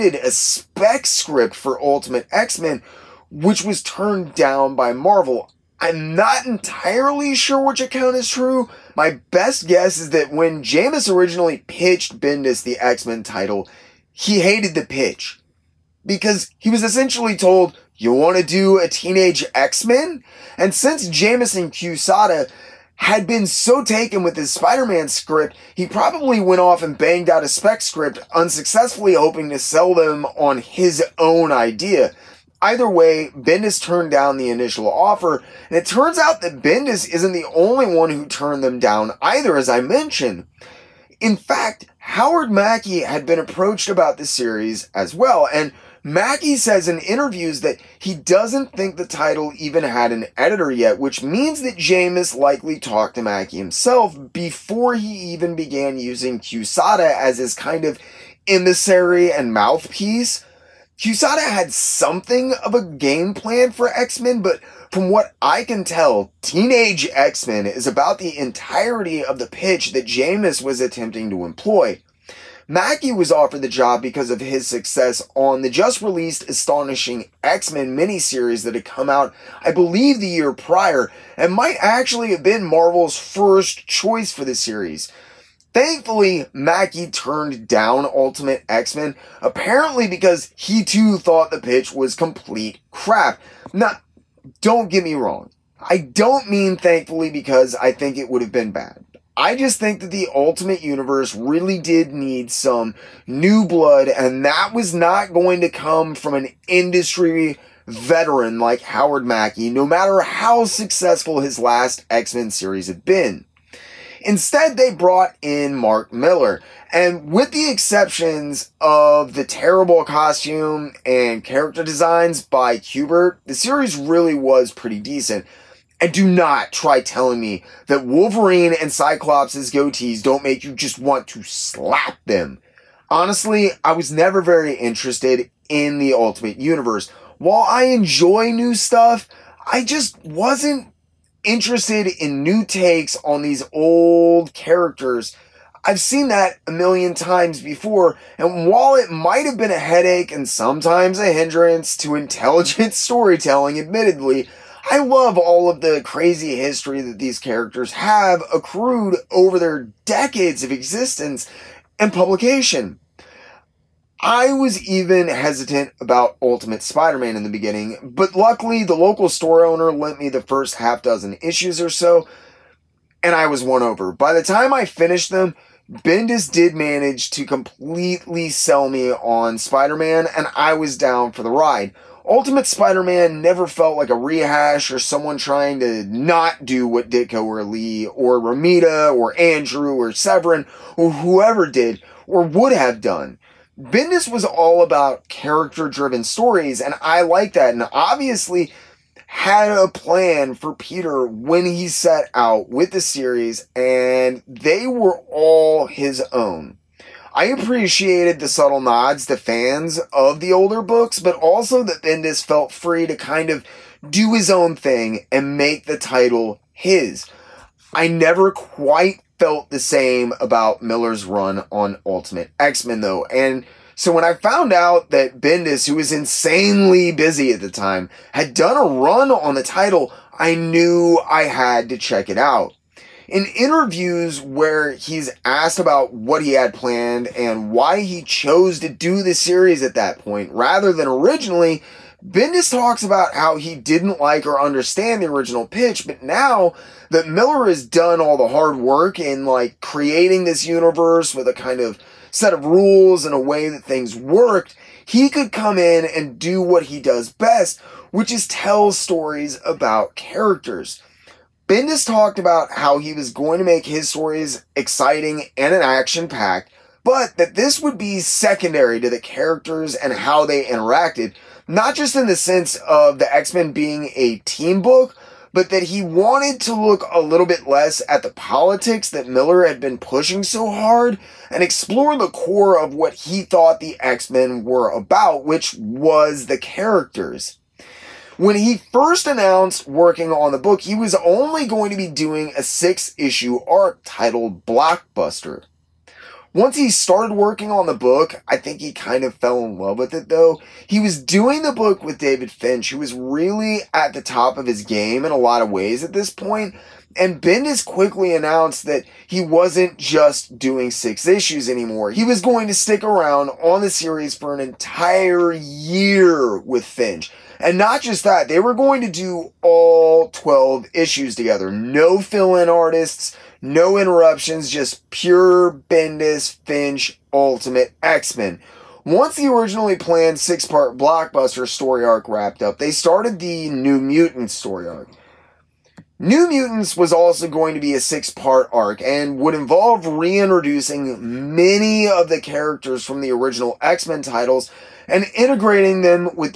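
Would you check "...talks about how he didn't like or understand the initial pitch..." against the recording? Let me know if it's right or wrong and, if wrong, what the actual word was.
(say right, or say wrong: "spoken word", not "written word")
wrong: "original", not "initial".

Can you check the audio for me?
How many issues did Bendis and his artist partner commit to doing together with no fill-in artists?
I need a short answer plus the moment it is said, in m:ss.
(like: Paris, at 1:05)
12, at 5:20.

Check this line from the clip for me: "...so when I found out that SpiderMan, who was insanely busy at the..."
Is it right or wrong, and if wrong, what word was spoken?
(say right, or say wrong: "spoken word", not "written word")
wrong: "Bendis", not "SpiderMan".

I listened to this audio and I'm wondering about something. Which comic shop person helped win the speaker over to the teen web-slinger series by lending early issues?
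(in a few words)
the local store owner.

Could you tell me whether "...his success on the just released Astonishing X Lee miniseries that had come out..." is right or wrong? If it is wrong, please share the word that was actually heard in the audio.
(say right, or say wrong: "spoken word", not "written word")
wrong: "Men", not "Lee".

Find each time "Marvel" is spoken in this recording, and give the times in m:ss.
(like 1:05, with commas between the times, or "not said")
0:04, 1:22.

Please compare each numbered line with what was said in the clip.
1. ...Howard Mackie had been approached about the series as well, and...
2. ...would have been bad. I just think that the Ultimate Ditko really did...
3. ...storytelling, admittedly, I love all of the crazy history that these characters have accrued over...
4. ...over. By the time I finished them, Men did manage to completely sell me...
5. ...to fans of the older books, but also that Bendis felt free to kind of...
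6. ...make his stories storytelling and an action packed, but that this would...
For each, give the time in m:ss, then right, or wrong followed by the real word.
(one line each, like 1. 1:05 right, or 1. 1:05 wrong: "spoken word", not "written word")
1. 0:41 right
2. 1:38 wrong: "Universe", not "Ditko"
3. 2:32 right
4. 2:53 wrong: "Bendis", not "Men"
5. 3:29 right
6. 4:23 wrong: "exciting", not "storytelling".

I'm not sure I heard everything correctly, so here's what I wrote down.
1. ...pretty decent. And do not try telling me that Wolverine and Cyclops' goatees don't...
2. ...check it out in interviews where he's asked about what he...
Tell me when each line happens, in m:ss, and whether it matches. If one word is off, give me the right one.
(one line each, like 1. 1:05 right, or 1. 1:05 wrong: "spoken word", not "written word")
1. 2:04 right
2. 3:51 right.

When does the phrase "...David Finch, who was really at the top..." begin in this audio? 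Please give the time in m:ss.
5:02.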